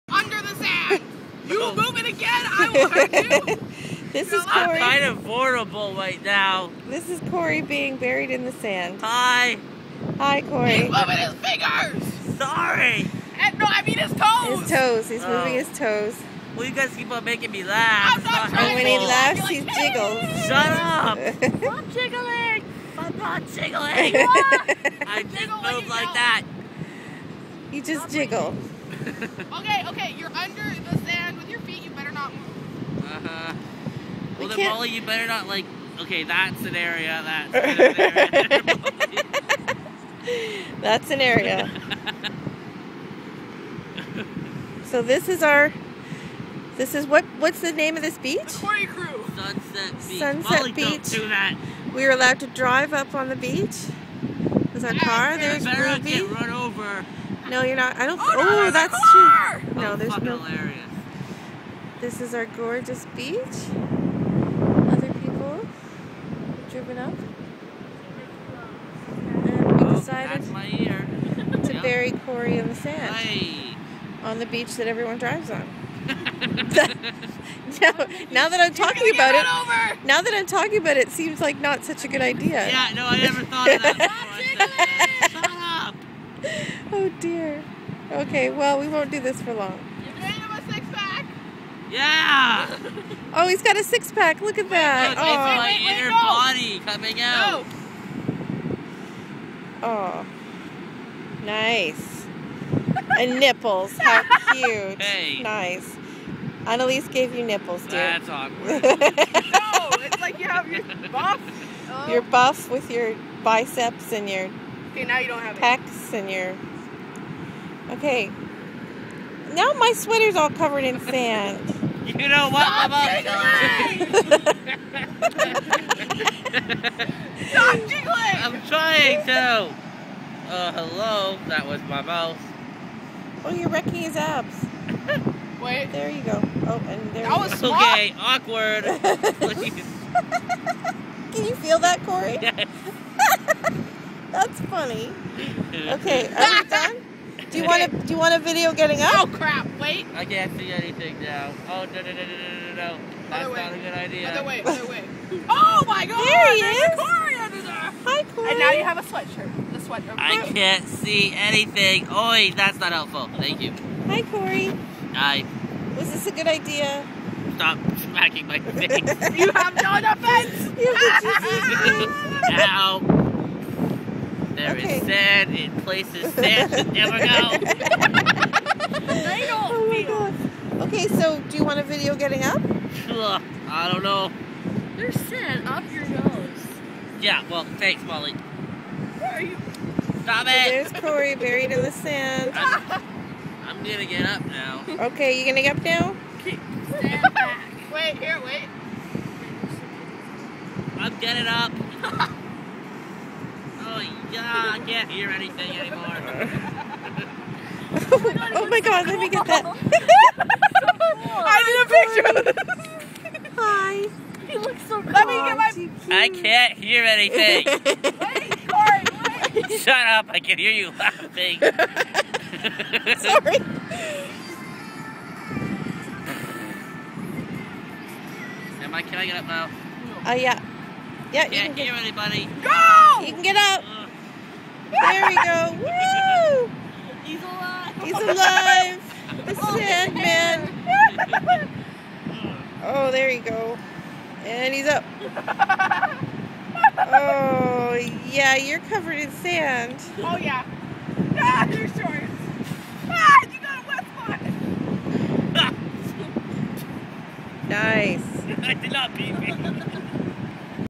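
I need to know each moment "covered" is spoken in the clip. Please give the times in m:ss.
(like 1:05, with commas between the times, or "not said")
2:00, 4:08.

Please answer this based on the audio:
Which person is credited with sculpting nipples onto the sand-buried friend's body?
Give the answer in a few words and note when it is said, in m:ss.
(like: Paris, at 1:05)
Annalise, at 1:46.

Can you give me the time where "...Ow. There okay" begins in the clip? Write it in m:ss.
2:52.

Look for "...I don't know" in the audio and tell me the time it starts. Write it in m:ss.
3:03.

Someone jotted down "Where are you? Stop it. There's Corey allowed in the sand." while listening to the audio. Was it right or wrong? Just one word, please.
wrong.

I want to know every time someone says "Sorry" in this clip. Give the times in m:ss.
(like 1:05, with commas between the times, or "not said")
0:12, 3:41.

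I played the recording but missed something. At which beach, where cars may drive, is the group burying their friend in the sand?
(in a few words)
Sunset Beach.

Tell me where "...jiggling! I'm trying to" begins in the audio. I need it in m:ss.
2:07.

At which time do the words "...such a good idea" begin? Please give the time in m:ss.
1:21.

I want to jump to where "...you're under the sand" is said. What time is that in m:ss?
0:30.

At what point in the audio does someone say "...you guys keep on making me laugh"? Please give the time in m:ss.
0:16.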